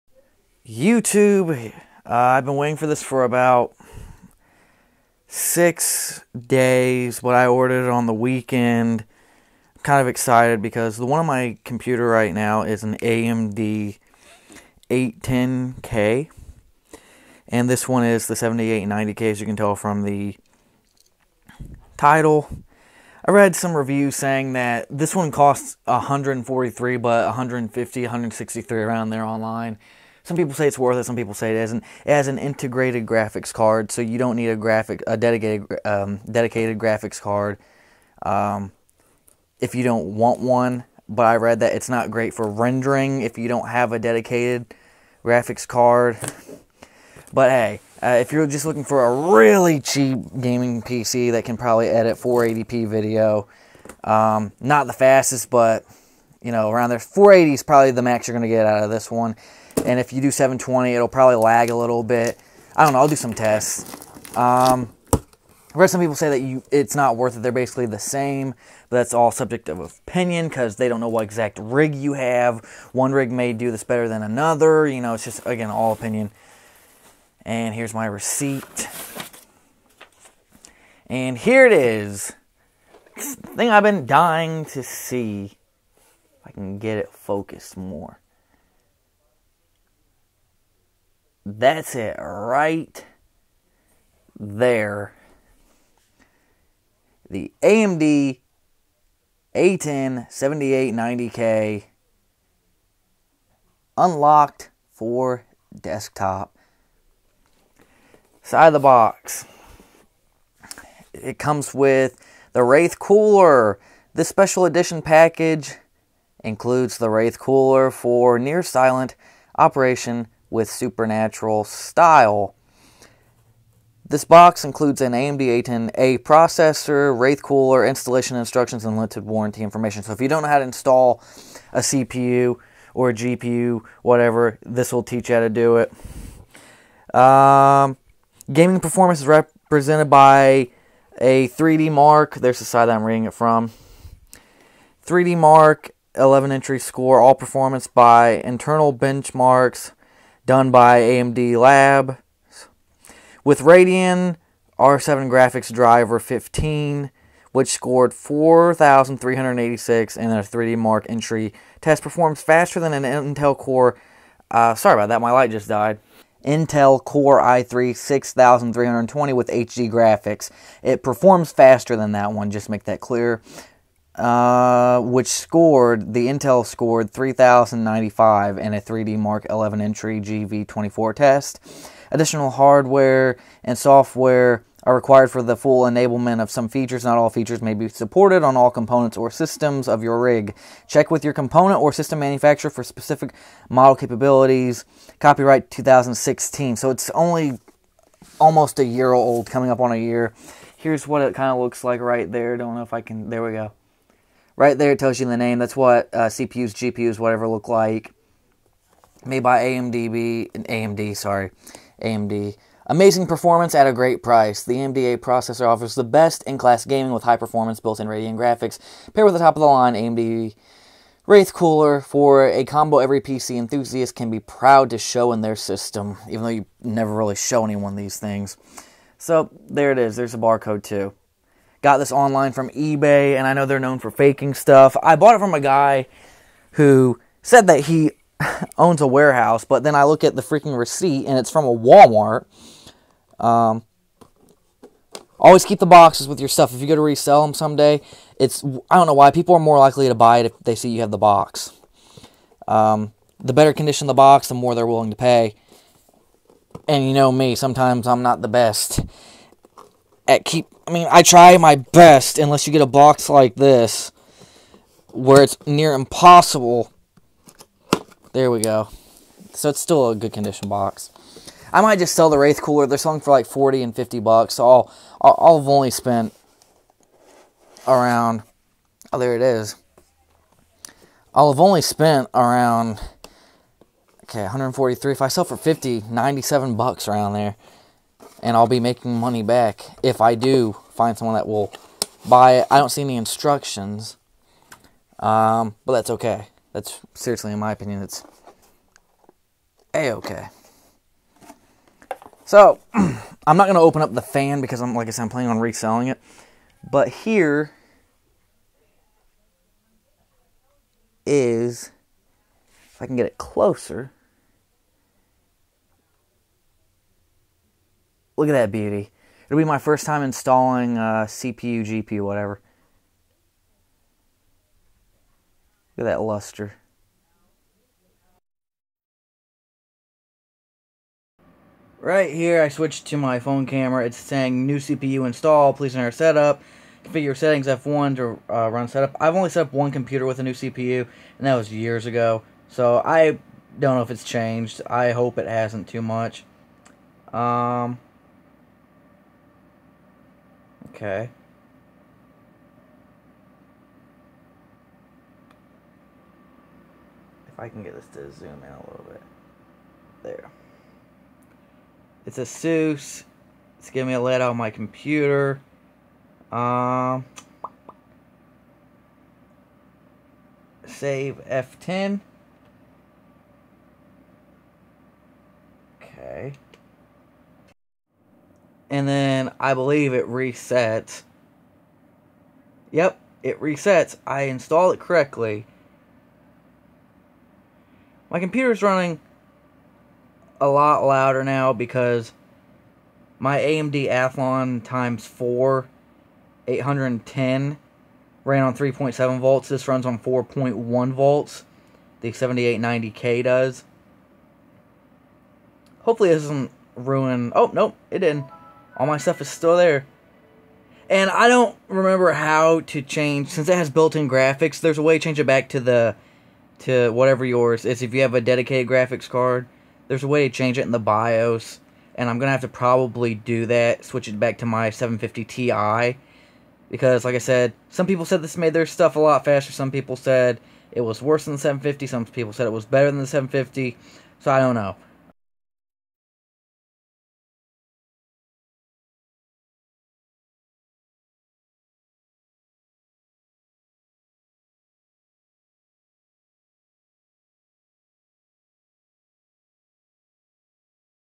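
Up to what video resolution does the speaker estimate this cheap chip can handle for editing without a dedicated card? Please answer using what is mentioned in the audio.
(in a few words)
480p.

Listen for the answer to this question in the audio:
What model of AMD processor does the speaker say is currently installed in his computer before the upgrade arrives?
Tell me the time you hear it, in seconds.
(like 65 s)
12 s.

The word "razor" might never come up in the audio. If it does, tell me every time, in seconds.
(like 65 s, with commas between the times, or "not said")
not said.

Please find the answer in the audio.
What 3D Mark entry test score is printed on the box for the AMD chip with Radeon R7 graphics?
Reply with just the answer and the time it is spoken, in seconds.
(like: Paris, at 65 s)
4,386, at 158 s.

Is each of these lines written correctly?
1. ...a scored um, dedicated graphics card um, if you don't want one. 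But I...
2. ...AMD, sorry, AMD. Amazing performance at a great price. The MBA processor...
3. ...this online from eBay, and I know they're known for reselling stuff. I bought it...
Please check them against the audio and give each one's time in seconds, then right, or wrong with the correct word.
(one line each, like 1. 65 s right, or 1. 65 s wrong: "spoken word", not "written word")
1. 35 s wrong: "dedicated", not "scored"
2. 210 s right
3. 231 s wrong: "faking", not "reselling".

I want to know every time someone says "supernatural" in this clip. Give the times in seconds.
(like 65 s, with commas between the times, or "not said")
120 s.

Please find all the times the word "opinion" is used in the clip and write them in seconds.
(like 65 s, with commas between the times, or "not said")
69 s, 75 s, 297 s.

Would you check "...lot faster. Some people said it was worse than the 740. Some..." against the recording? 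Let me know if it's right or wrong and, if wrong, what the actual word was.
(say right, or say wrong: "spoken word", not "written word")
wrong: "750", not "740".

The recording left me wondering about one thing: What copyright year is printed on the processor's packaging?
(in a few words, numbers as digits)
2016.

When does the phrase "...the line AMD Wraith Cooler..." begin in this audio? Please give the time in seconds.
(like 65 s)
219 s.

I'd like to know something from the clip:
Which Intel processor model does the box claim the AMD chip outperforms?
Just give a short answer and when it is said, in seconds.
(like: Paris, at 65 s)
Intel Core i3 6320, at 166 s.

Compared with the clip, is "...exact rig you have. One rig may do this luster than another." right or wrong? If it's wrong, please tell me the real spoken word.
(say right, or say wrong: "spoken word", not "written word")
wrong: "better", not "luster".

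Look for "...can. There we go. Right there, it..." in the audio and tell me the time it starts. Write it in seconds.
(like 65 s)
203 s.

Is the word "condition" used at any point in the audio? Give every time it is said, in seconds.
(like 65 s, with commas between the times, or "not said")
253 s, 270 s.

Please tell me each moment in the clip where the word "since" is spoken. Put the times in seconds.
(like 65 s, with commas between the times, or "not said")
413 s.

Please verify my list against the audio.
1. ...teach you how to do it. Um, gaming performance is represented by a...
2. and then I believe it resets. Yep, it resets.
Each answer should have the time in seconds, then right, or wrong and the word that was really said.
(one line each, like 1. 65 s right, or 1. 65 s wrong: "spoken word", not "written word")
1. 135 s right
2. 378 s right.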